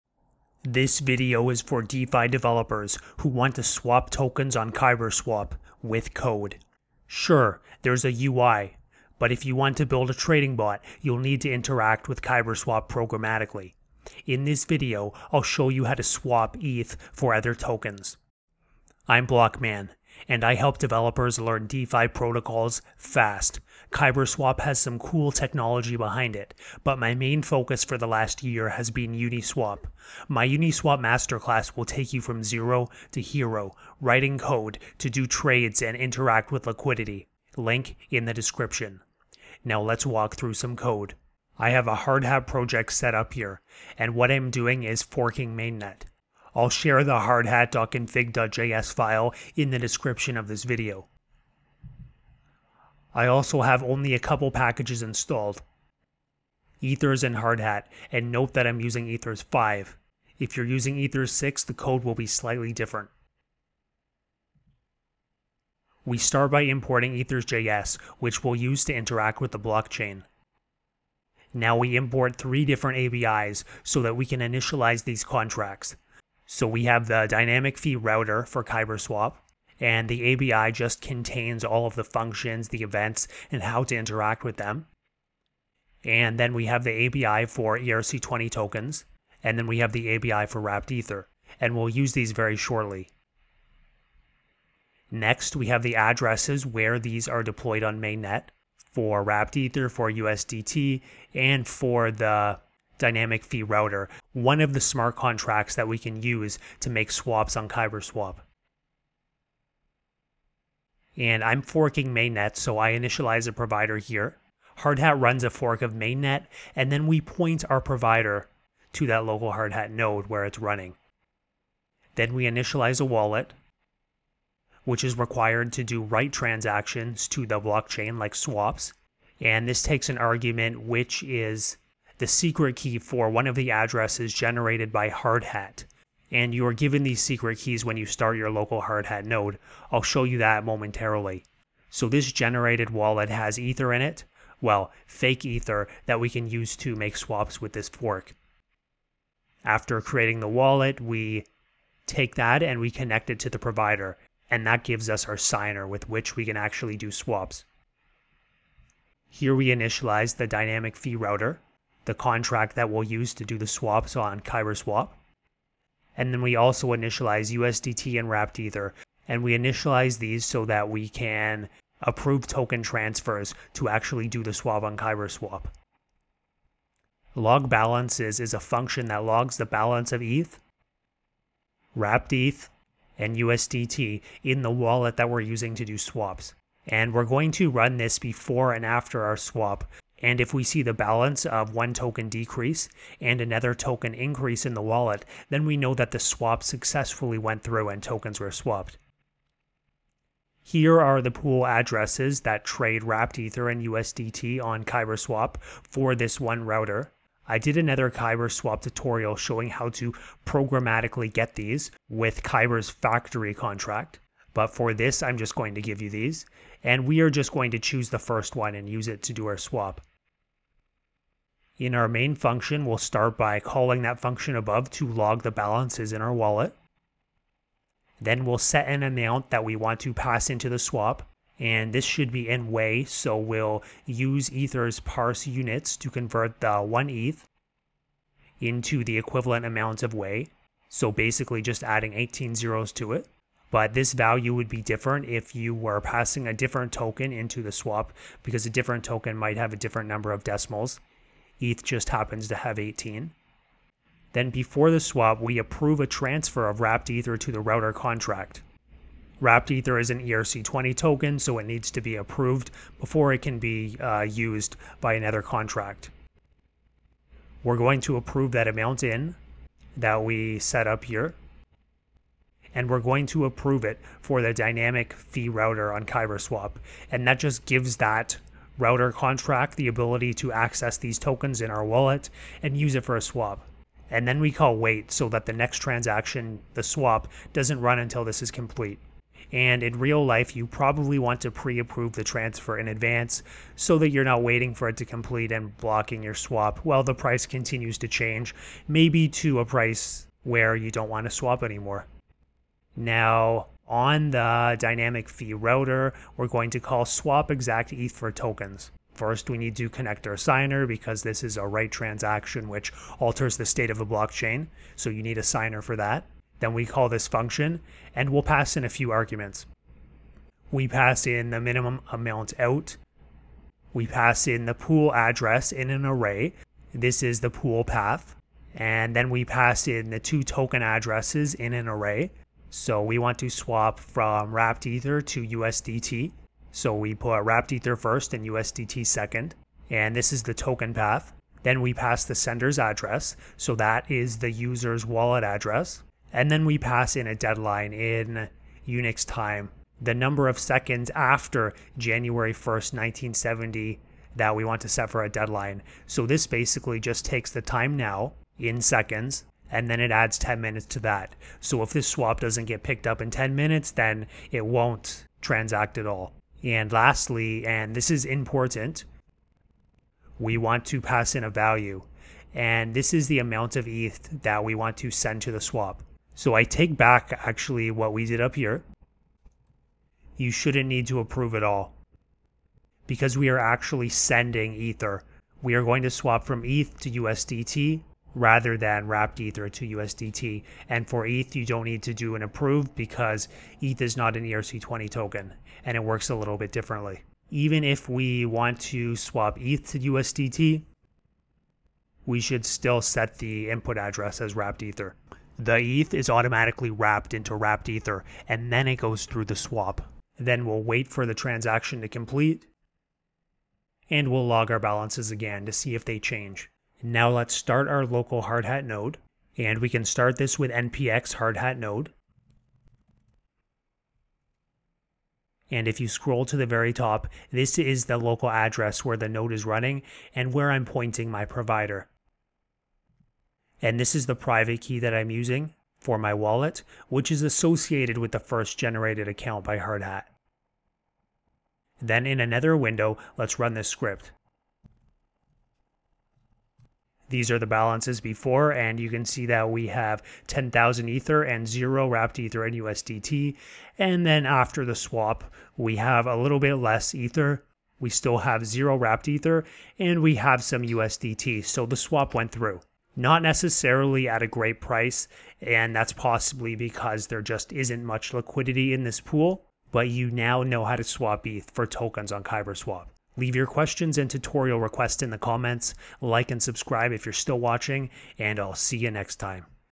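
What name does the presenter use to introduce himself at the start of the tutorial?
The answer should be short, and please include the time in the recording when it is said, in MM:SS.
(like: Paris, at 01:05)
Blockman, at 00:19.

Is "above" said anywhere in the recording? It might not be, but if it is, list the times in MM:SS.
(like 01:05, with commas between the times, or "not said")
03:44.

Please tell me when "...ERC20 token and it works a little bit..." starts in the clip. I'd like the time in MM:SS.
06:34.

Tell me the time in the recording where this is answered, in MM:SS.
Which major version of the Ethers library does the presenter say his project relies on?
00:59.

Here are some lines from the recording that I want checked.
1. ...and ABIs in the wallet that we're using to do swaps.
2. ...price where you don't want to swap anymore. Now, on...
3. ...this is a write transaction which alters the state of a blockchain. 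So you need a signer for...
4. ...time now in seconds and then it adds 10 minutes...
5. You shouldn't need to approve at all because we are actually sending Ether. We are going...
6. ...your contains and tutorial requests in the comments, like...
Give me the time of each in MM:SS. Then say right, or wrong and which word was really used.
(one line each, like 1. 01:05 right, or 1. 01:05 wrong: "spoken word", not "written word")
1. 03:03 wrong: "USDT", not "ABIs"
2. 04:59 right
3. 05:11 right
4. 05:57 right
5. 06:20 right
6. 07:53 wrong: "questions", not "contains".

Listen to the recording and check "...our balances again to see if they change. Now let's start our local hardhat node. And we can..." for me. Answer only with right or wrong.
right.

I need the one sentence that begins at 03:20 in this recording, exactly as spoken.
Here are the pool addresses that trade wrapped Ether and USDT on KyberSwap for this one router.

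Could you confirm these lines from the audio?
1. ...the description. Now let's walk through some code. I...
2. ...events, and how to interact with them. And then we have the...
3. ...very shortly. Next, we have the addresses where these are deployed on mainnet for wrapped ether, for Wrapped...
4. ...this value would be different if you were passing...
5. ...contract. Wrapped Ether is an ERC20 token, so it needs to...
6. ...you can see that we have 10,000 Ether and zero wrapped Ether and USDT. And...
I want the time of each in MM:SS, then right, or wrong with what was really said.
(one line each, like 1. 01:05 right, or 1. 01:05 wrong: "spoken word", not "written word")
1. 00:38 right
2. 01:22 right
3. 01:32 wrong: "USDT", not "Wrapped"
4. 04:03 right
5. 04:17 right
6. 07:28 right.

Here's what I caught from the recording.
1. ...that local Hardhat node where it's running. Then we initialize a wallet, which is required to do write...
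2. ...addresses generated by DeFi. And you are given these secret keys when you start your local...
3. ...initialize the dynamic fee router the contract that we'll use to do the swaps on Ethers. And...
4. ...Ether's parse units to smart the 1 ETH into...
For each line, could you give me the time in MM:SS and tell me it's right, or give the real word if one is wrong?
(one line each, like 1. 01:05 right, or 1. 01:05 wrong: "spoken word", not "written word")
1. 01:59 right
2. 02:13 wrong: "Hardhat", not "DeFi"
3. 02:39 wrong: "Kyberswap", not "Ethers"
4. 03:54 wrong: "convert", not "smart".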